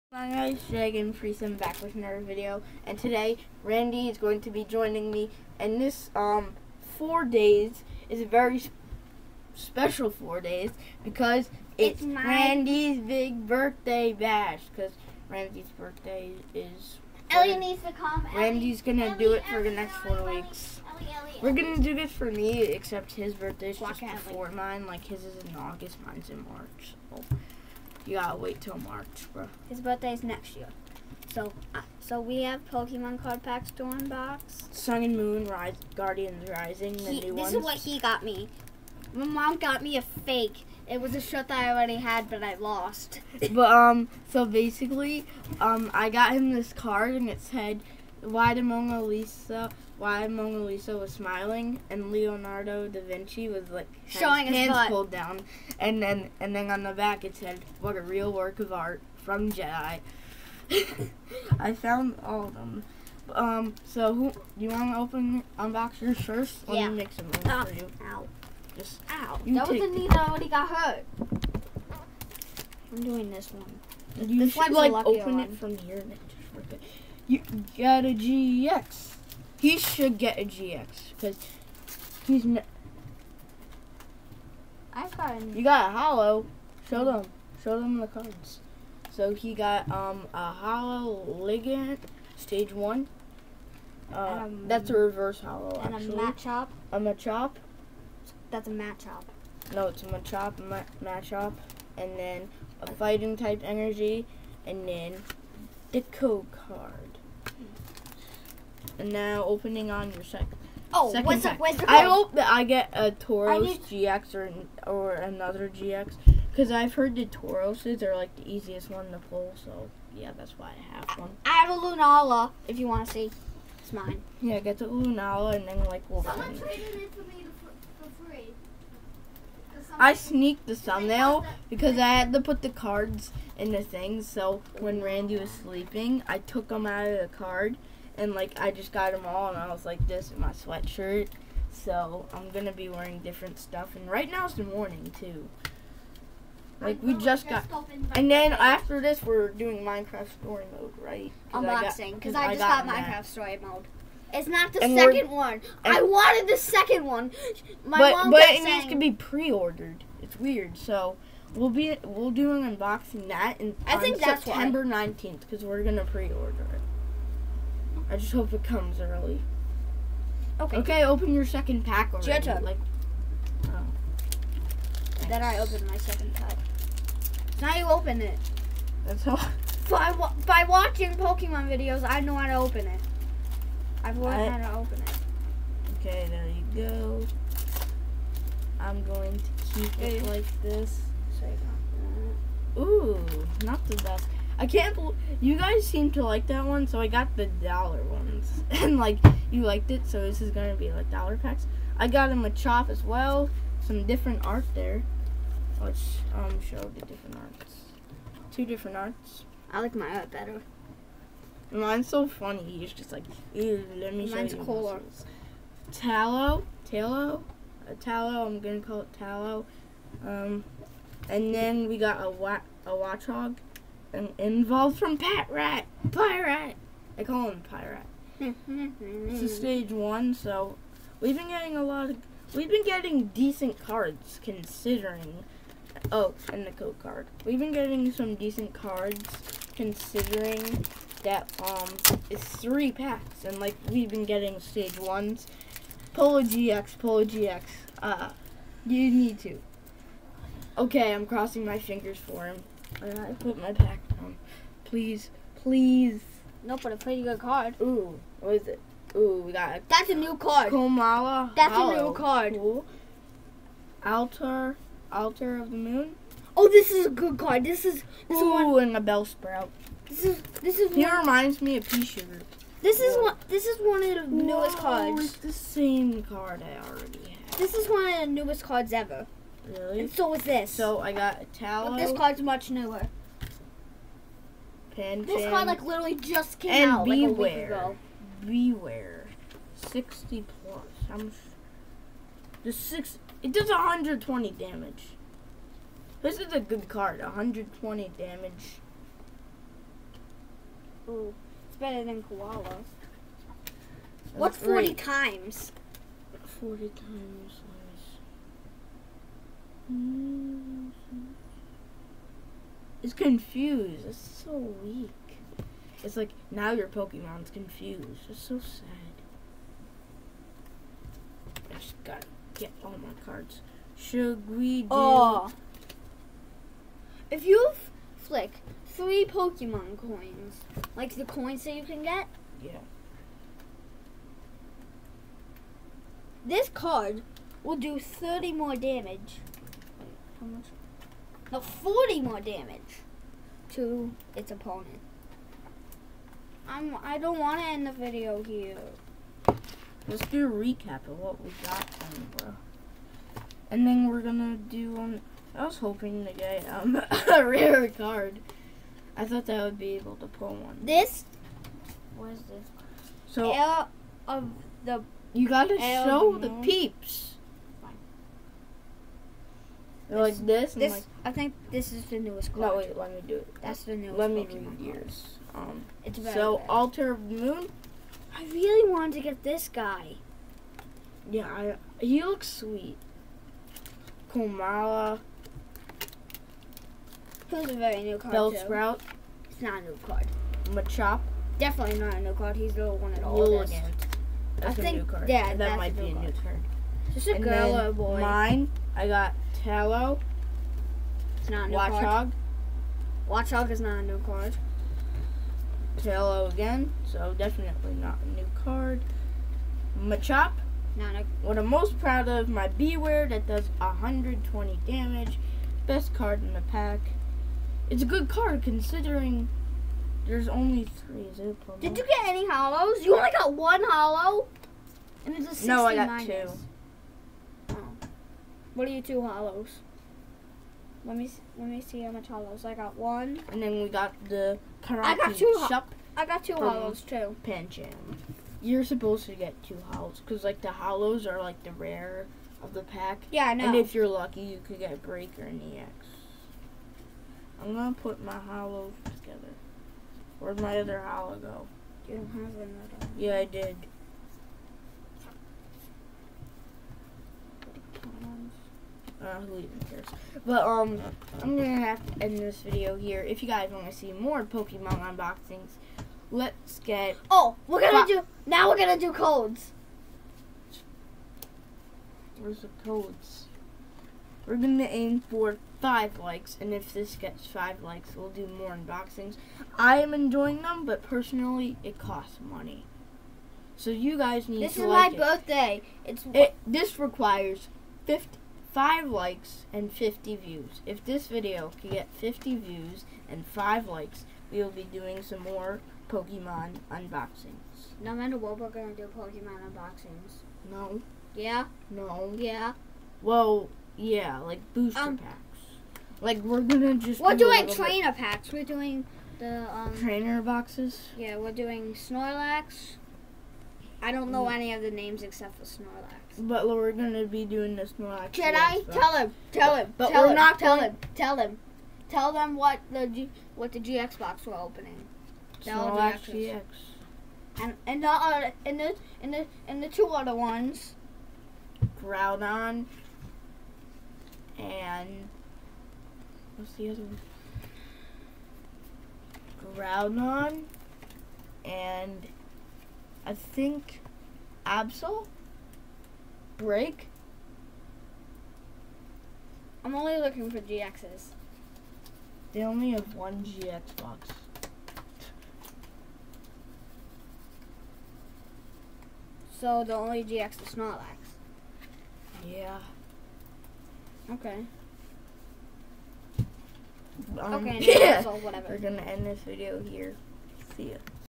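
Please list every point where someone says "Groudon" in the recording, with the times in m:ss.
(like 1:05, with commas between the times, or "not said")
8:52, 8:59.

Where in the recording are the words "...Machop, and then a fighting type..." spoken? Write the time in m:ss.
1:41.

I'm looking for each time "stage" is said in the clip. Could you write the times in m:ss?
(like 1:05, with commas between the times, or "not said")
1:32, 3:49, 4:04.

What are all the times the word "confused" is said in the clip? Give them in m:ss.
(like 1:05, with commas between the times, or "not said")
5:13, 5:17.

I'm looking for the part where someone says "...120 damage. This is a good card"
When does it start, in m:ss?
4:53.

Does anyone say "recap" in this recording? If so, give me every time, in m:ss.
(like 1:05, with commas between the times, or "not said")
5:50.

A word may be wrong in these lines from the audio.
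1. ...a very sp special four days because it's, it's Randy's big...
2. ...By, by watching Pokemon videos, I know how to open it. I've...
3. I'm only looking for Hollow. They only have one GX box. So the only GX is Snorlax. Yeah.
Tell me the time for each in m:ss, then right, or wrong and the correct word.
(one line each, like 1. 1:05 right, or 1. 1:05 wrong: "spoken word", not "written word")
1. 0:08 right
2. 2:59 right
3. 9:09 wrong: "GXs", not "Hollow".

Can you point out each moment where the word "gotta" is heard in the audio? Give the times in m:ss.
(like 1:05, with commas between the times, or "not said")
0:28, 5:22, 6:05.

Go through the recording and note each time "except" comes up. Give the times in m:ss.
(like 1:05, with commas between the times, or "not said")
0:22, 8:35.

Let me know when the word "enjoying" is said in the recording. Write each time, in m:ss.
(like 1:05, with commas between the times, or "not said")
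8:00.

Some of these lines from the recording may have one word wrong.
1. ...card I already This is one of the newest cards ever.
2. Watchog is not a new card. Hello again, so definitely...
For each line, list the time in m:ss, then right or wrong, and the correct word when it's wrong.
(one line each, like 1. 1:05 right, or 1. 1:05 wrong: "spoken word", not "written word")
1. 4:36 right
2. 6:43 right.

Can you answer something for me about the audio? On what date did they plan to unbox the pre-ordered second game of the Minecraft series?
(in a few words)
September 19.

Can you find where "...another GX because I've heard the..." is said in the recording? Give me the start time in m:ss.
1:55.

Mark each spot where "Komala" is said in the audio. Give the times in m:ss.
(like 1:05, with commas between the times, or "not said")
4:20, 5:02, 6:24.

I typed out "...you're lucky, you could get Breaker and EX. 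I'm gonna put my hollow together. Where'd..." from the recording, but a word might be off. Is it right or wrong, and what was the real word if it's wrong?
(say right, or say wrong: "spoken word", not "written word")
right.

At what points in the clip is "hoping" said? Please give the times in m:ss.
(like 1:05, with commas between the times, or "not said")
5:55.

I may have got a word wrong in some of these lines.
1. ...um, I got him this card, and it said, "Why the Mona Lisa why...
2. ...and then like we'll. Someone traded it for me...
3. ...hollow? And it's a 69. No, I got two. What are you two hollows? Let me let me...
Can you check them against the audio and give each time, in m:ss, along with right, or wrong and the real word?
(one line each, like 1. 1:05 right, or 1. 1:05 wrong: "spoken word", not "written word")
1. 0:45 right
2. 2:05 right
3. 7:03 right.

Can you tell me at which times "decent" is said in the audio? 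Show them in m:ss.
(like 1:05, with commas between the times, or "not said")
3:53, 3:58.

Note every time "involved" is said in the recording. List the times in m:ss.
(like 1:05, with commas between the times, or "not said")
3:44.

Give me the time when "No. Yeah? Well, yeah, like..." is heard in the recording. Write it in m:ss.
8:21.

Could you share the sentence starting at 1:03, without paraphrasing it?
Um, so who, you want to open unbox yours first?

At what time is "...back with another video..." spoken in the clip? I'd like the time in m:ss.
0:01.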